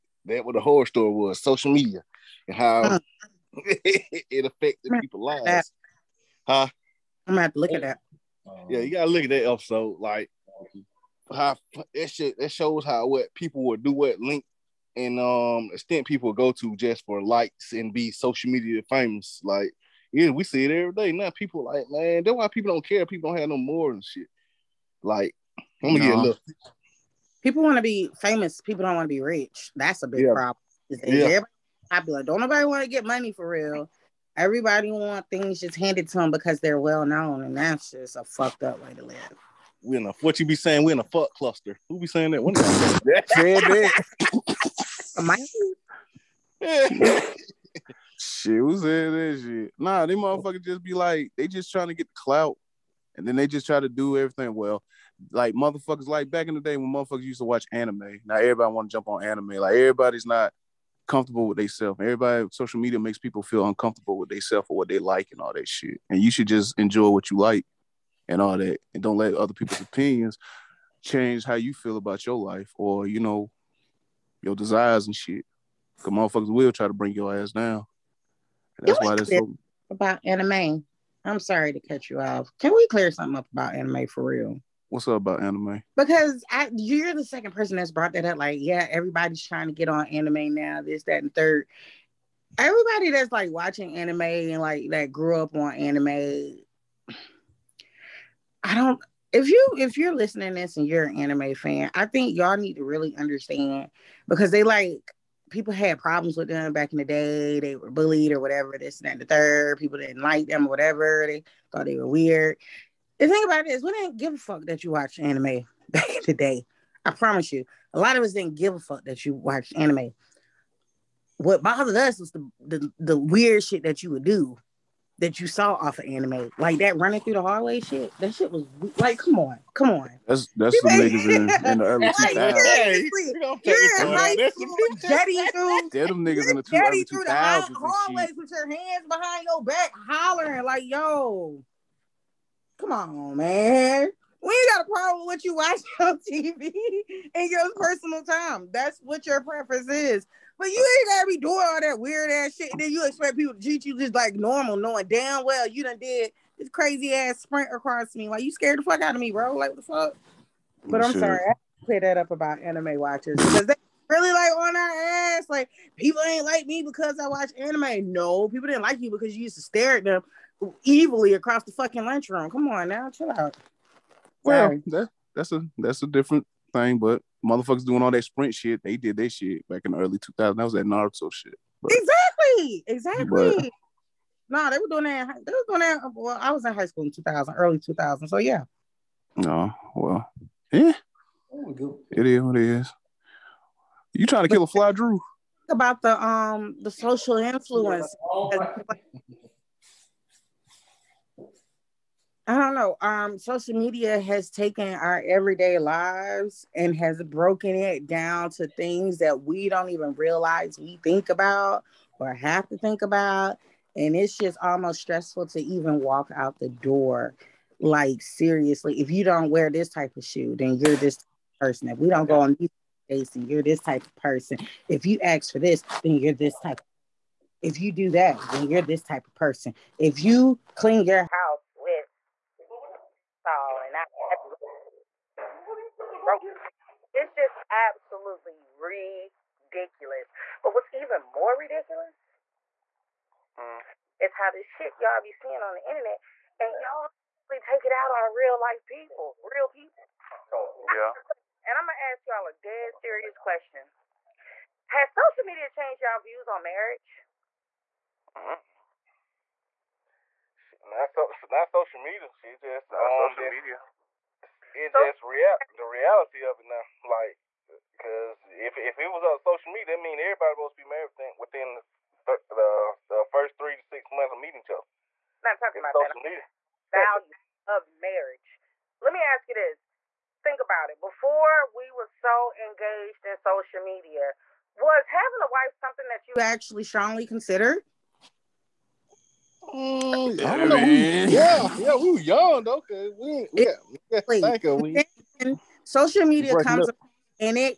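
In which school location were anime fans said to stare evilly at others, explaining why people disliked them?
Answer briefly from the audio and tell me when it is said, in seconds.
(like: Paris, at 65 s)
lunchroom, at 172 s.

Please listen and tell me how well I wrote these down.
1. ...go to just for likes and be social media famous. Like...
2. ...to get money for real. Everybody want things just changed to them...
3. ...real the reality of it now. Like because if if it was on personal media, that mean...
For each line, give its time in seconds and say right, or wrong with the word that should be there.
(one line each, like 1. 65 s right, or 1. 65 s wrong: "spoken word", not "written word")
1. 16 s right
2. 32 s wrong: "handed", not "changed"
3. 265 s wrong: "social", not "personal".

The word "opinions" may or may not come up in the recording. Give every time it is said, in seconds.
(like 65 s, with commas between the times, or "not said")
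69 s.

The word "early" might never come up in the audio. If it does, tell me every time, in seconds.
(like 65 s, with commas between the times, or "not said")
131 s, 179 s, 187 s.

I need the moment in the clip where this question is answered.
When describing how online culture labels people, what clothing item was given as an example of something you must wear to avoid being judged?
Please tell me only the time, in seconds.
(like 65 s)
220 s.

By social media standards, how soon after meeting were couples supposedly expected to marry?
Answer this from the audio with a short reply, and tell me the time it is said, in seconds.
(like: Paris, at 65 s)
3 to 6 months, at 273 s.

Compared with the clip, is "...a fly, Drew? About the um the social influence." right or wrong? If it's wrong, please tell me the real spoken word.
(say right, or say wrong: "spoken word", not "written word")
right.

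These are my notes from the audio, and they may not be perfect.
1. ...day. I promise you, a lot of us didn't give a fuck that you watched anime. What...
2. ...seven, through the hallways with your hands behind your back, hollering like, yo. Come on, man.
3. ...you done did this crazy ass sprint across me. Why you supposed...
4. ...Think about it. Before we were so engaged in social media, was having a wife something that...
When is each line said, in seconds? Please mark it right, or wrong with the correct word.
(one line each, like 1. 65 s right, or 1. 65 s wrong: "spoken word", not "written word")
1. 116 s right
2. 136 s wrong: "two", not "seven"
3. 155 s wrong: "scared", not "supposed"
4. 280 s right.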